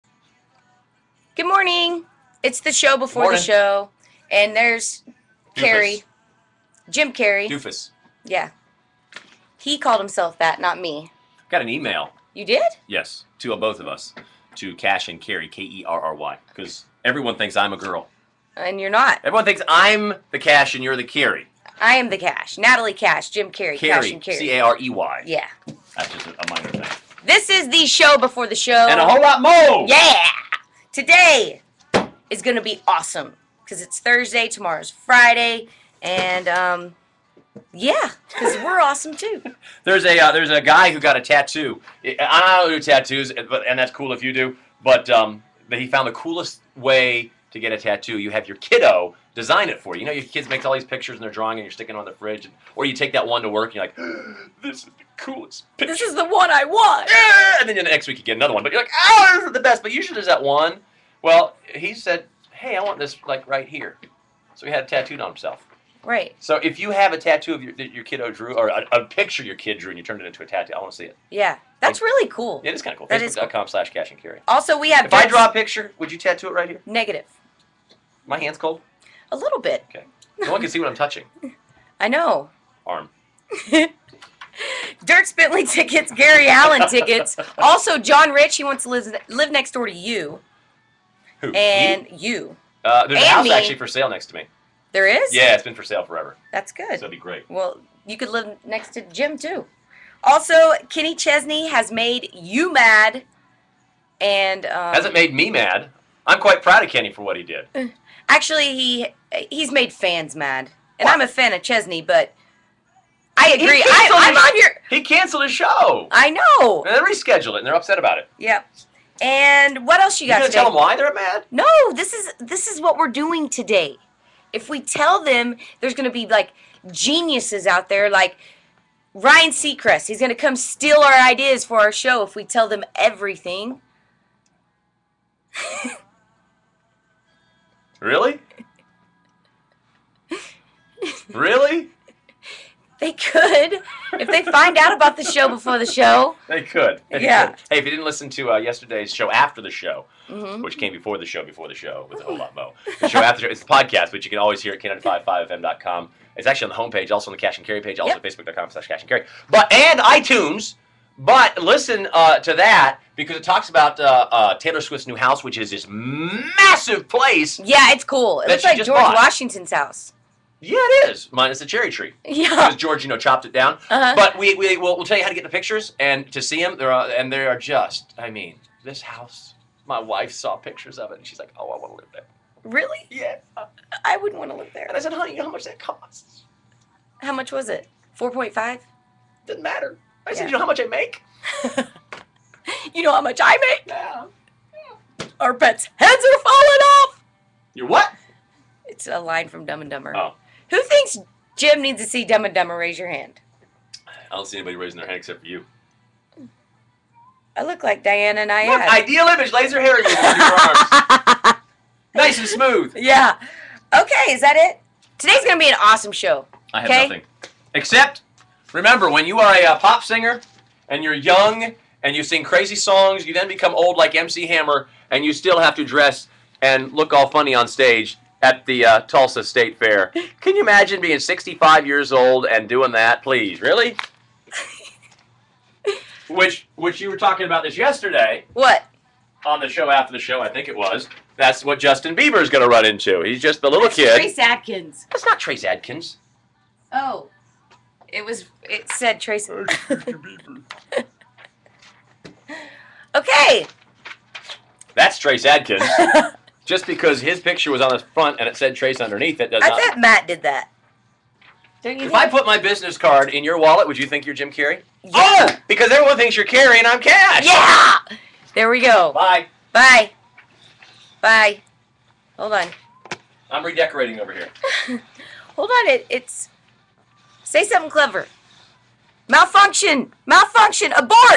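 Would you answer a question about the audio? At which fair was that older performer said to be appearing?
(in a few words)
Tulsa State Fair.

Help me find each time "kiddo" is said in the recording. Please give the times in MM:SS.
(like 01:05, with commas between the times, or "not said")
00:48, 01:08.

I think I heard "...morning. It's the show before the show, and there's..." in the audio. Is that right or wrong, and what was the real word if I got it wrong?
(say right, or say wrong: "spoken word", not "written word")
right.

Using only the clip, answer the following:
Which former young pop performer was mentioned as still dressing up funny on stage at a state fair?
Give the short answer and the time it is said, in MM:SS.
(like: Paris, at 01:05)
MC Hammer, at 03:44.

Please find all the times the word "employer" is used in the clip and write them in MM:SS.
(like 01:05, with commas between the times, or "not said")
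not said.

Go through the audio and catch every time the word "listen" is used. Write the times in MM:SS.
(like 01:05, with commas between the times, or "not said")
02:28, 02:41.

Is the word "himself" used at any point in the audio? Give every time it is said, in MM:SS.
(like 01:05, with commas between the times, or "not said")
00:10, 01:05.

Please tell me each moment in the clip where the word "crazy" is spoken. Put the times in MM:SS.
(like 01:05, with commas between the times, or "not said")
03:42.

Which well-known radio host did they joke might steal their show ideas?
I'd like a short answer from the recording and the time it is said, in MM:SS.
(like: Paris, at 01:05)
Ryan Seacrest, at 02:09.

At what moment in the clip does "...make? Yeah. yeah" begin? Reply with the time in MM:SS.
03:13.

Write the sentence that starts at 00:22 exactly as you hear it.
Natalie Cash, Jim Carey, Cash Carrie, and Carrie.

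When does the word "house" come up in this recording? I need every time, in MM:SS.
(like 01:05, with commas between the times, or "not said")
01:33, 02:45, 02:49, 02:59.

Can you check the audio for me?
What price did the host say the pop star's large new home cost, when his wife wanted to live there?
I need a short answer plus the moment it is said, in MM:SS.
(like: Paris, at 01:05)
4.5 million, at 03:08.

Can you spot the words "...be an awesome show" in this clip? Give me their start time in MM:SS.
03:35.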